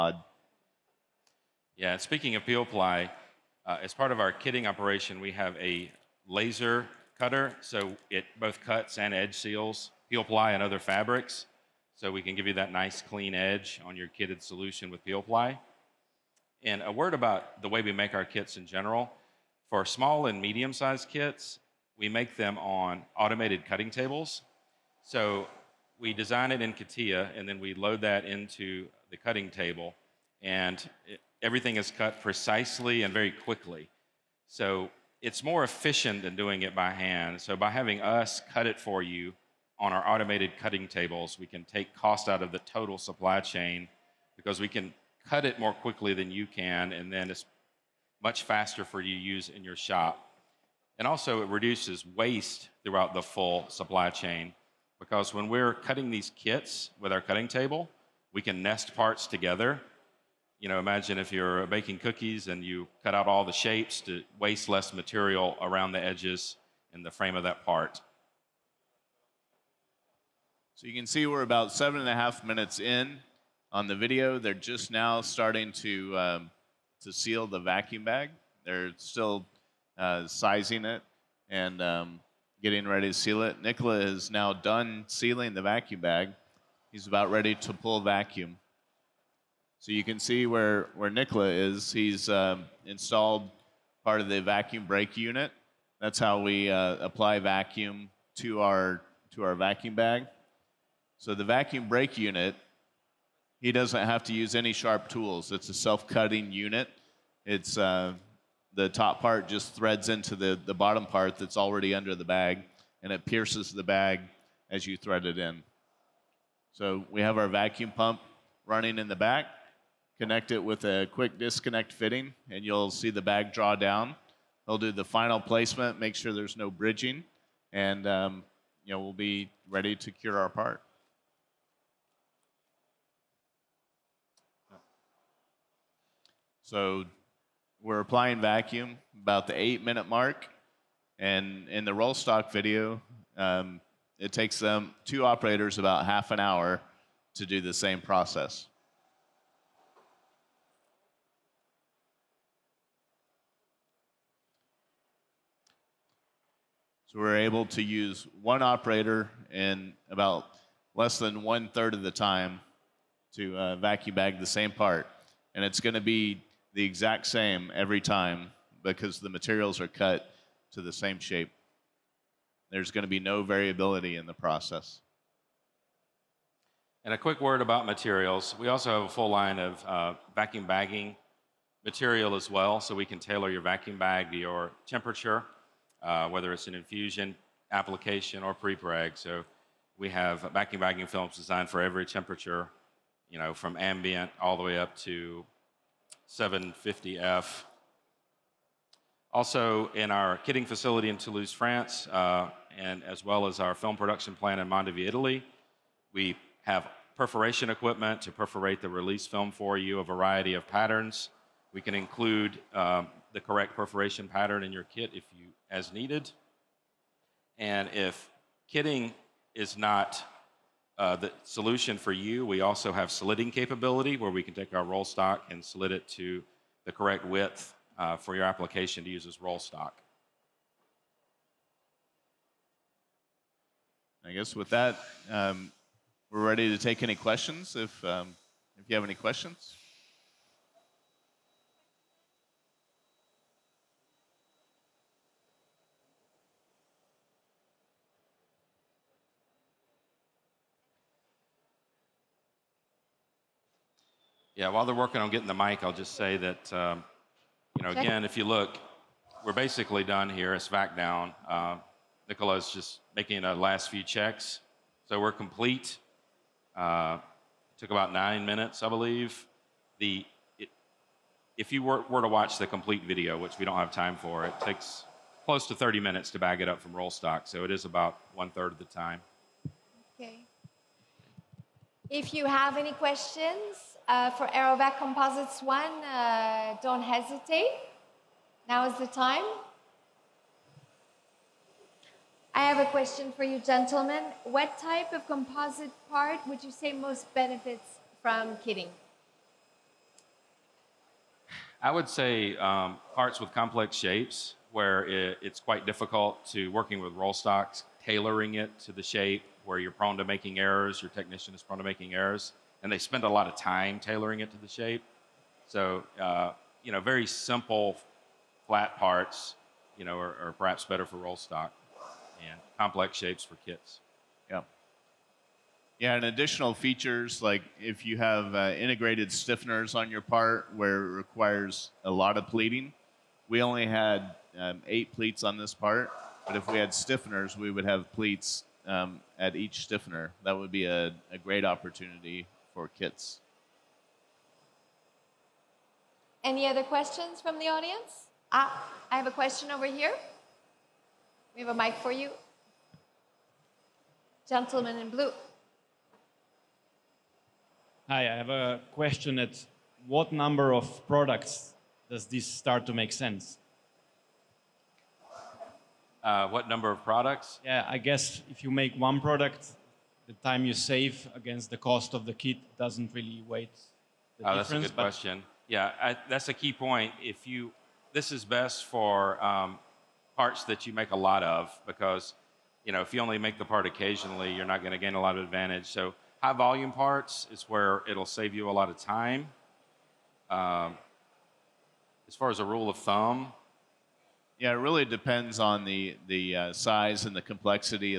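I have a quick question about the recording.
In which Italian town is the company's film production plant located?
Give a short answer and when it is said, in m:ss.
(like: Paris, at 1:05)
Mondovì, at 3:24.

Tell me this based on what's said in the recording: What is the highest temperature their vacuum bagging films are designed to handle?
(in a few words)
750F.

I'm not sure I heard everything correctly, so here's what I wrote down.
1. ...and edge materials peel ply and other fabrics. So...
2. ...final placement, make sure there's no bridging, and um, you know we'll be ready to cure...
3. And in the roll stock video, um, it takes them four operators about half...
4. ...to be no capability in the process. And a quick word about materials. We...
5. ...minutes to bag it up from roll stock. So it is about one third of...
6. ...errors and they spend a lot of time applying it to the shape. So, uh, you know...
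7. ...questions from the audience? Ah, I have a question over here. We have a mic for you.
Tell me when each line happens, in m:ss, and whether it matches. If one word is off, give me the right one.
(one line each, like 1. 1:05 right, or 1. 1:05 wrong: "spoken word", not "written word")
1. 0:08 wrong: "seals", not "materials"
2. 2:05 right
3. 2:21 wrong: "two", not "four"
4. 2:53 wrong: "variability", not "capability"
5. 4:35 right
6. 5:12 wrong: "tailoring", not "applying"
7. 5:46 right.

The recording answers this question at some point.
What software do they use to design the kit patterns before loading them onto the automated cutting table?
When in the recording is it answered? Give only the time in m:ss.
0:26.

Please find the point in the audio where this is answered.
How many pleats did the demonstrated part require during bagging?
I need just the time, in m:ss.
5:34.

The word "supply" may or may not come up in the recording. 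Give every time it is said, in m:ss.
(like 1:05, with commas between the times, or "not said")
0:42, 0:53.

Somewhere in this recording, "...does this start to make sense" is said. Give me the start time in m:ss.
6:02.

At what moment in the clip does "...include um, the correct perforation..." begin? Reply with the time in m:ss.
3:31.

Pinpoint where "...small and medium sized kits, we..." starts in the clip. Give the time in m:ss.
0:19.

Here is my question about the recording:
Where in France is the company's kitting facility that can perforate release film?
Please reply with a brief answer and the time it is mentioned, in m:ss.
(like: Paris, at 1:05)
Toulouse, at 3:21.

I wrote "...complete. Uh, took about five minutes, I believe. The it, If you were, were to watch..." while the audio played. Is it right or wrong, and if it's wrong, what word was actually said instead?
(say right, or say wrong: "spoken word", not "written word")
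wrong: "nine", not "five".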